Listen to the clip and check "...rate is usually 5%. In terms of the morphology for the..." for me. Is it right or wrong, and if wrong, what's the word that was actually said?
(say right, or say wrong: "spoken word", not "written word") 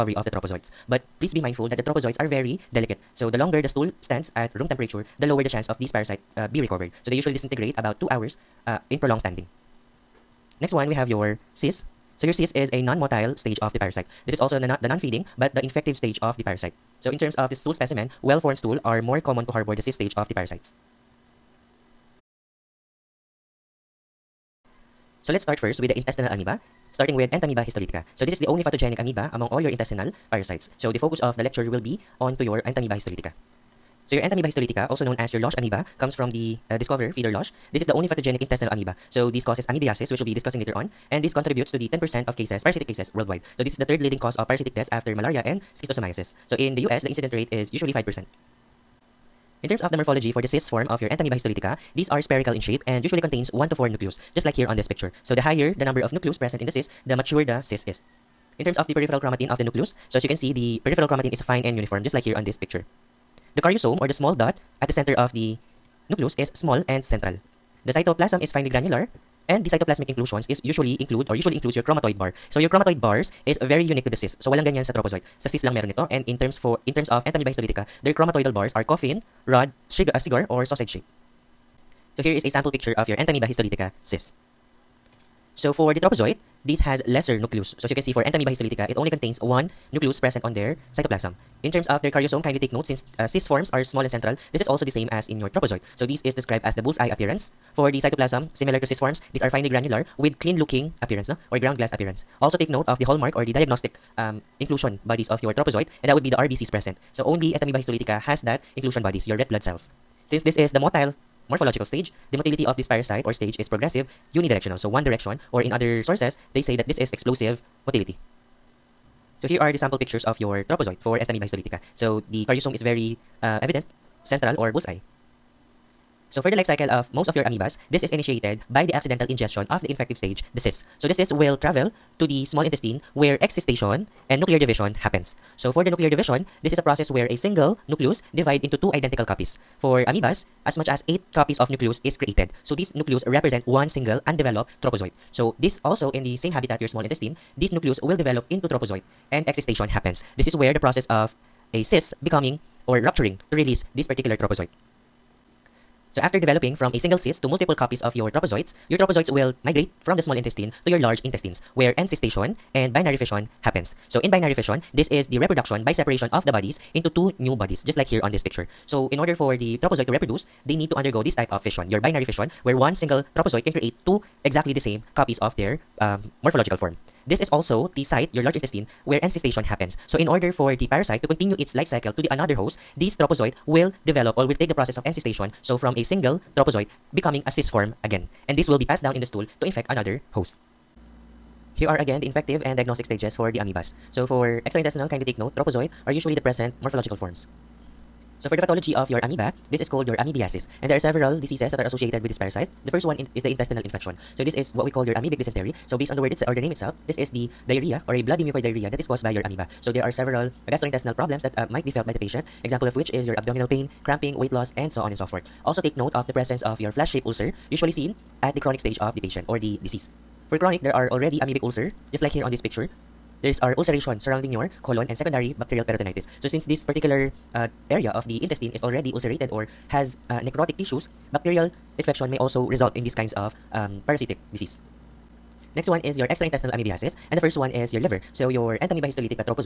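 right.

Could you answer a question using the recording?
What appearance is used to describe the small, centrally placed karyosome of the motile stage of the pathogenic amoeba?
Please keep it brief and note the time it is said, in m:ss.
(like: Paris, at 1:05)
bullseye appearance, at 1:36.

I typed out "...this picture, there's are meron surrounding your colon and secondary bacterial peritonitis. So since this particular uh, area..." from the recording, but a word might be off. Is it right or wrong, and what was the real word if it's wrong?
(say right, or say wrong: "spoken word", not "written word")
wrong: "ulceration", not "meron".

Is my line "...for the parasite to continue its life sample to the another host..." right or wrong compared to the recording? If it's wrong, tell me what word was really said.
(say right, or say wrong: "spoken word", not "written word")
wrong: "cycle", not "sample".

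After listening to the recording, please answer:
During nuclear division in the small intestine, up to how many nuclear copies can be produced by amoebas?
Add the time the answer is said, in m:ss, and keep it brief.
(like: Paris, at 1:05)
8, at 2:21.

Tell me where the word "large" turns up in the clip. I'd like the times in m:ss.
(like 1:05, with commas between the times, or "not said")
2:40, 2:58.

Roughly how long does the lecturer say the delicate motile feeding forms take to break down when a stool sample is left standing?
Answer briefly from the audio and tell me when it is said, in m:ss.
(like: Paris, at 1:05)
2 hours, at 0:08.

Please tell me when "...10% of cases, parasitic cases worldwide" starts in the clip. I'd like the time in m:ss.
0:41.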